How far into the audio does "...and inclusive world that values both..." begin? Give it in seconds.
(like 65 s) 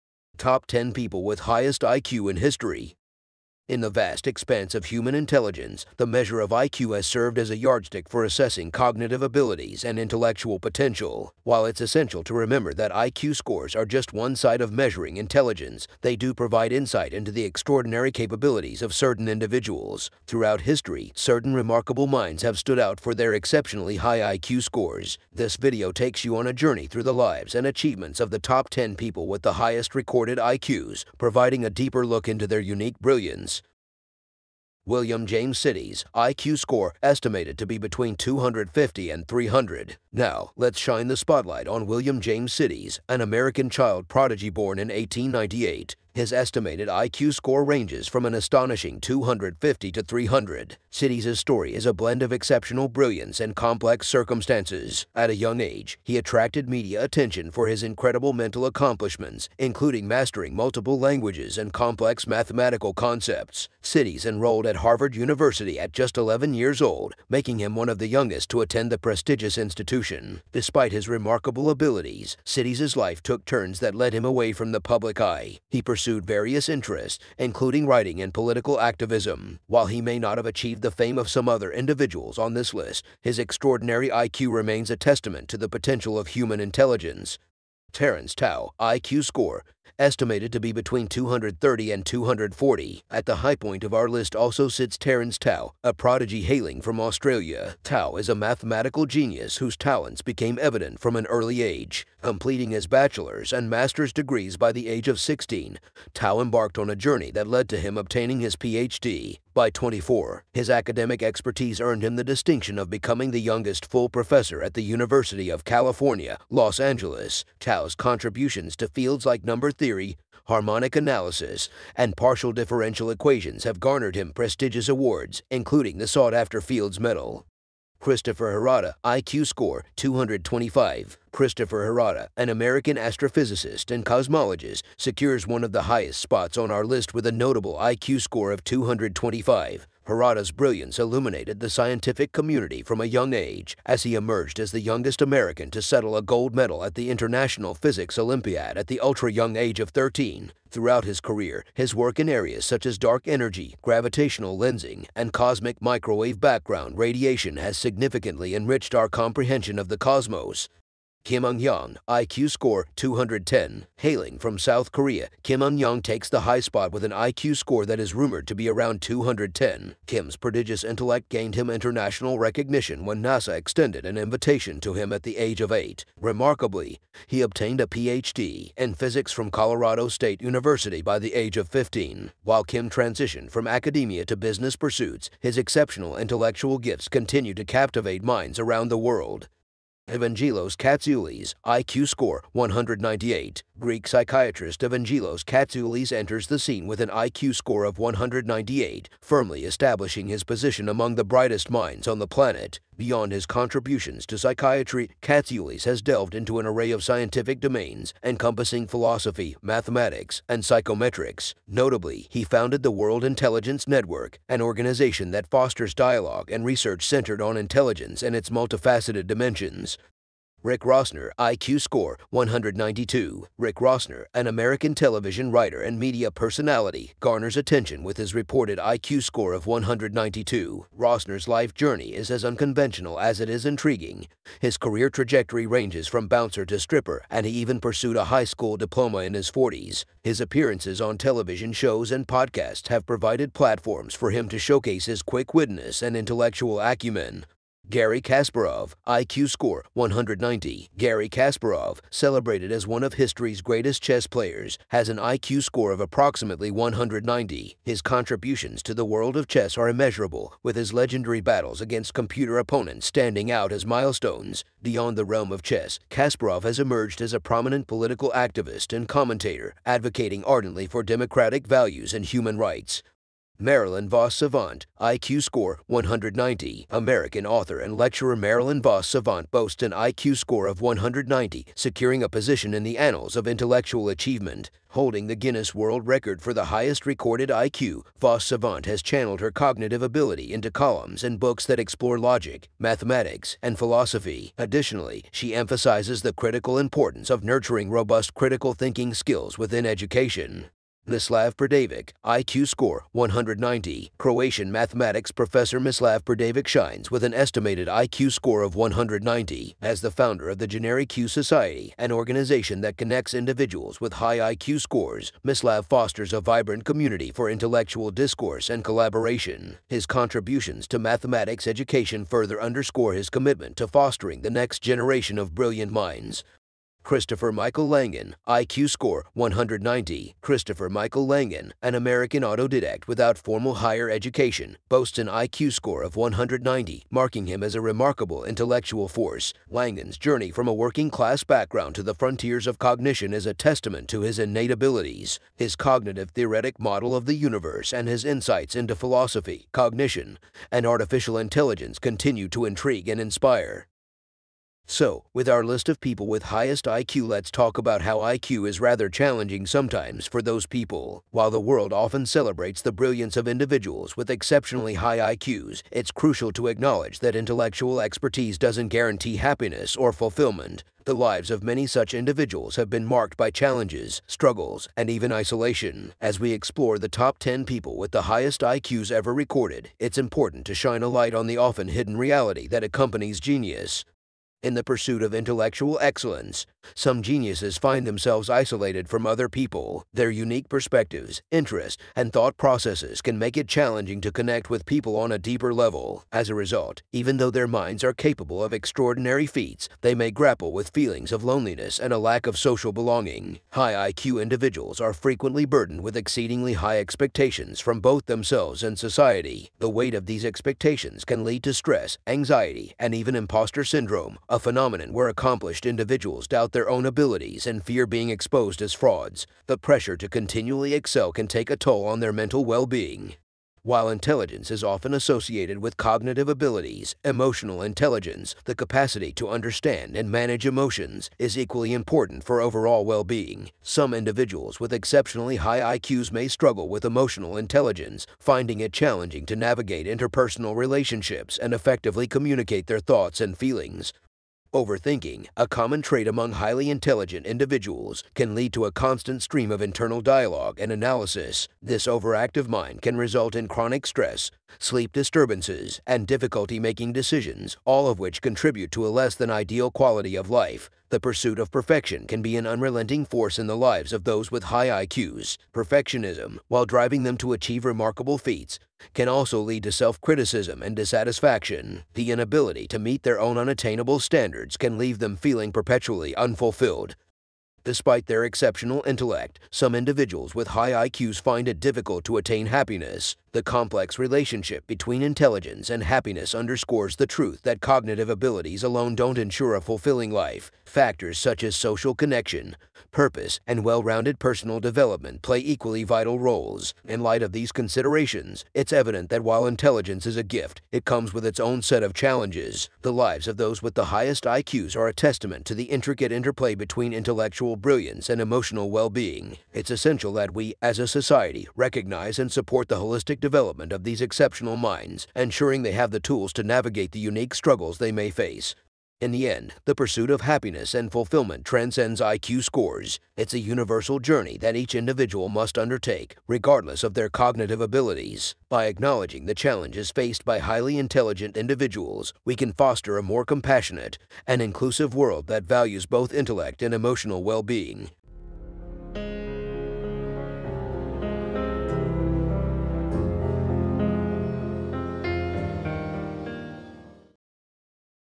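534 s.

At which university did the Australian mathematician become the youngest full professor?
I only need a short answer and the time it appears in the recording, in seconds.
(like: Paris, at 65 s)
University of California, Los Angeles, at 114 s.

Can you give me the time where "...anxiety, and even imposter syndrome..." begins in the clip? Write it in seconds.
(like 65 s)
412 s.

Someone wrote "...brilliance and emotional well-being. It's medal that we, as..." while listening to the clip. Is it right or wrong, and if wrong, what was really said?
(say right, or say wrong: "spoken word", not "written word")
wrong: "essential", not "medal".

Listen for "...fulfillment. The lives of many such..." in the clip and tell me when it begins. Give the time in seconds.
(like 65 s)
370 s.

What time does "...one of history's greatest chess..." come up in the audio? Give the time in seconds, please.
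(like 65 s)
252 s.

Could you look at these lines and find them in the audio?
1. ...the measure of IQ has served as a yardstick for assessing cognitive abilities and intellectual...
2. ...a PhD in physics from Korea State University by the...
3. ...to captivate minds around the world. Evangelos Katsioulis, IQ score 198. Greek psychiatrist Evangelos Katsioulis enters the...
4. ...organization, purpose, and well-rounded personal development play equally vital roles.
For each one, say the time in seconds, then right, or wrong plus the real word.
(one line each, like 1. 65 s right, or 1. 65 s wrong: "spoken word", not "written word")
1. 5 s right
2. 177 s wrong: "Colorado", not "Korea"
3. 187 s right
4. 492 s wrong: "connection", not "organization".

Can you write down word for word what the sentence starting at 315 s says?
Mislav fosters a vibrant community for intellectual discourse and collaboration.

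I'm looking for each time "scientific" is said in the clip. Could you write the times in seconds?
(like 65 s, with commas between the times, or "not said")
141 s, 207 s.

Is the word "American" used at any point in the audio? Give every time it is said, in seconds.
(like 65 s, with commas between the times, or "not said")
43 s, 132 s, 145 s, 224 s, 276 s, 331 s.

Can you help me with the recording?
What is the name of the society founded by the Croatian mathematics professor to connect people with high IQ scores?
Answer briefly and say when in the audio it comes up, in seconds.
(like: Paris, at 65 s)
GenerIQ Society, at 310 s.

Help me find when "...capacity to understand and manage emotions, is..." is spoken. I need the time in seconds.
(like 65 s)
428 s.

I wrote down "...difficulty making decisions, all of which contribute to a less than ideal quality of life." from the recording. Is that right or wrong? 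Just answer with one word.
right.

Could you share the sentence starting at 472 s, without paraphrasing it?
The inability to meet their own unattainable standards can leave them feeling perpetually unfulfilled.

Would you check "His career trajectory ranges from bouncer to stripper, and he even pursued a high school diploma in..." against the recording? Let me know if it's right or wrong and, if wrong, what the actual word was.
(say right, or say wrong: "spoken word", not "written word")
right.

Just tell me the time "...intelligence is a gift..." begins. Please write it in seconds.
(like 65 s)
499 s.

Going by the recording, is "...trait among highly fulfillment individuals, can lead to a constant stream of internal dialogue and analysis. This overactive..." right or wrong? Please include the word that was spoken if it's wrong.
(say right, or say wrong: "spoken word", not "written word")
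wrong: "intelligent", not "fulfillment".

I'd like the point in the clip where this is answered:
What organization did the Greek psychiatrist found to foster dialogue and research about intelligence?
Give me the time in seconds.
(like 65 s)
212 s.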